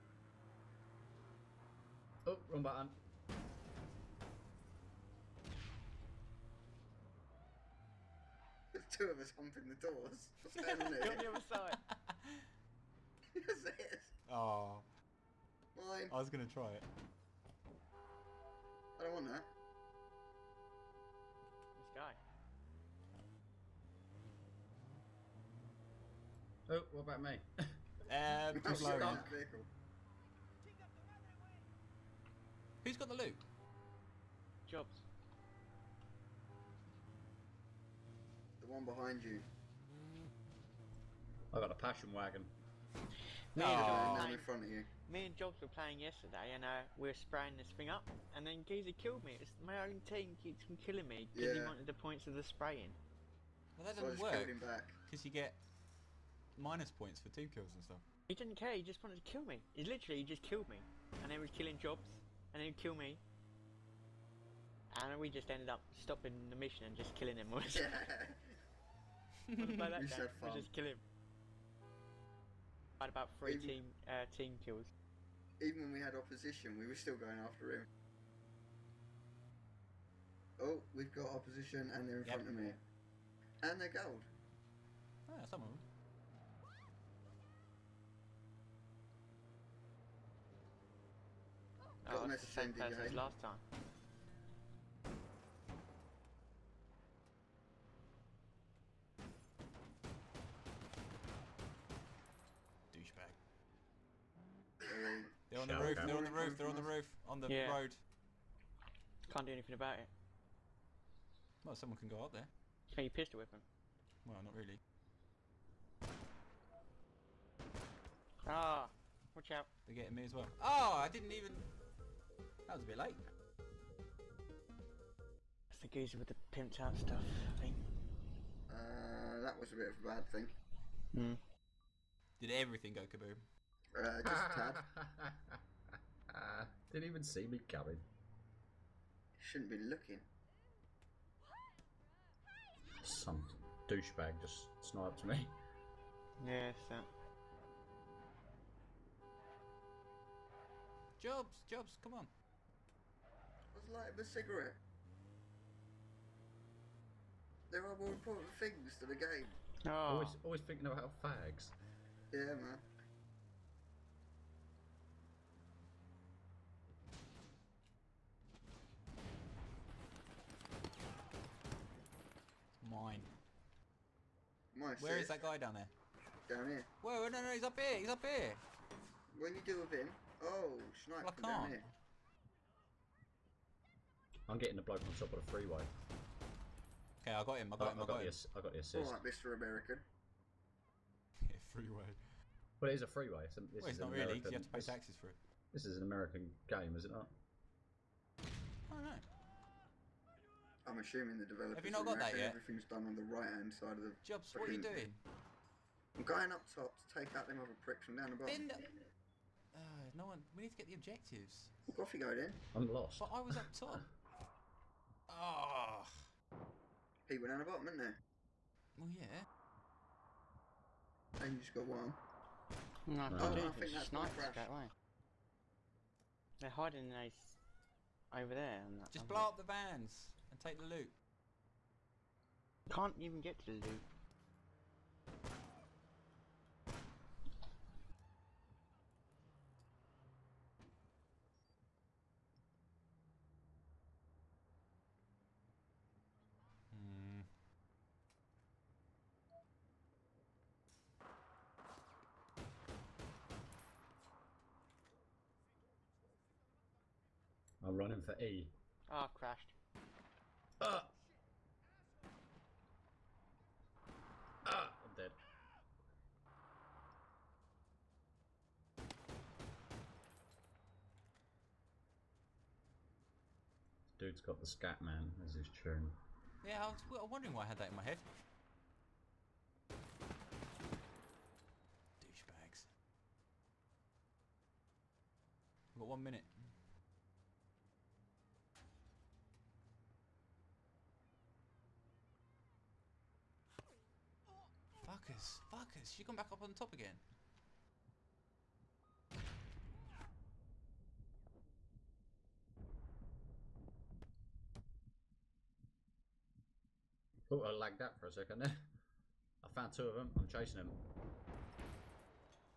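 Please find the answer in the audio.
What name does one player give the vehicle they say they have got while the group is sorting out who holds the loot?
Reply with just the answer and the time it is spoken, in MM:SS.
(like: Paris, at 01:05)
Passion wagon, at 00:41.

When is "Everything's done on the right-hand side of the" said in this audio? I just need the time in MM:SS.
03:22.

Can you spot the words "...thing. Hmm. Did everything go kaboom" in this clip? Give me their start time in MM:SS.
02:10.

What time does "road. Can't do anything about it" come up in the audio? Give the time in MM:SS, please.
01:47.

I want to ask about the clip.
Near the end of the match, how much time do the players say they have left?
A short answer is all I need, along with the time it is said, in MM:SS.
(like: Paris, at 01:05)
1 minute, at 04:46.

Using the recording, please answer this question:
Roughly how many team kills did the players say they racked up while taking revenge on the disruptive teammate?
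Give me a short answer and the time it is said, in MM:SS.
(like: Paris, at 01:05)
3, at 01:13.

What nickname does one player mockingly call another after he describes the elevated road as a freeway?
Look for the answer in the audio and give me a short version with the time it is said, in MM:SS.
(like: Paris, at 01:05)
Mr. American, at 03:09.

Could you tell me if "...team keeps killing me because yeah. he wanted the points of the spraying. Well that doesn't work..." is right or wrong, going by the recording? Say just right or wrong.
right.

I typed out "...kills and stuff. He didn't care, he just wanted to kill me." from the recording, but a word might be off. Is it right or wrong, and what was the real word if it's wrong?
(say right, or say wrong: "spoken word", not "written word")
right.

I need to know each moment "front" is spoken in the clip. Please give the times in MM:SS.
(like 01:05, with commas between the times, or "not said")
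00:44, 01:22.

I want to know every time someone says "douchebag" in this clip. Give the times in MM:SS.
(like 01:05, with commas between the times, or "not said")
01:42, 02:23, 04:42.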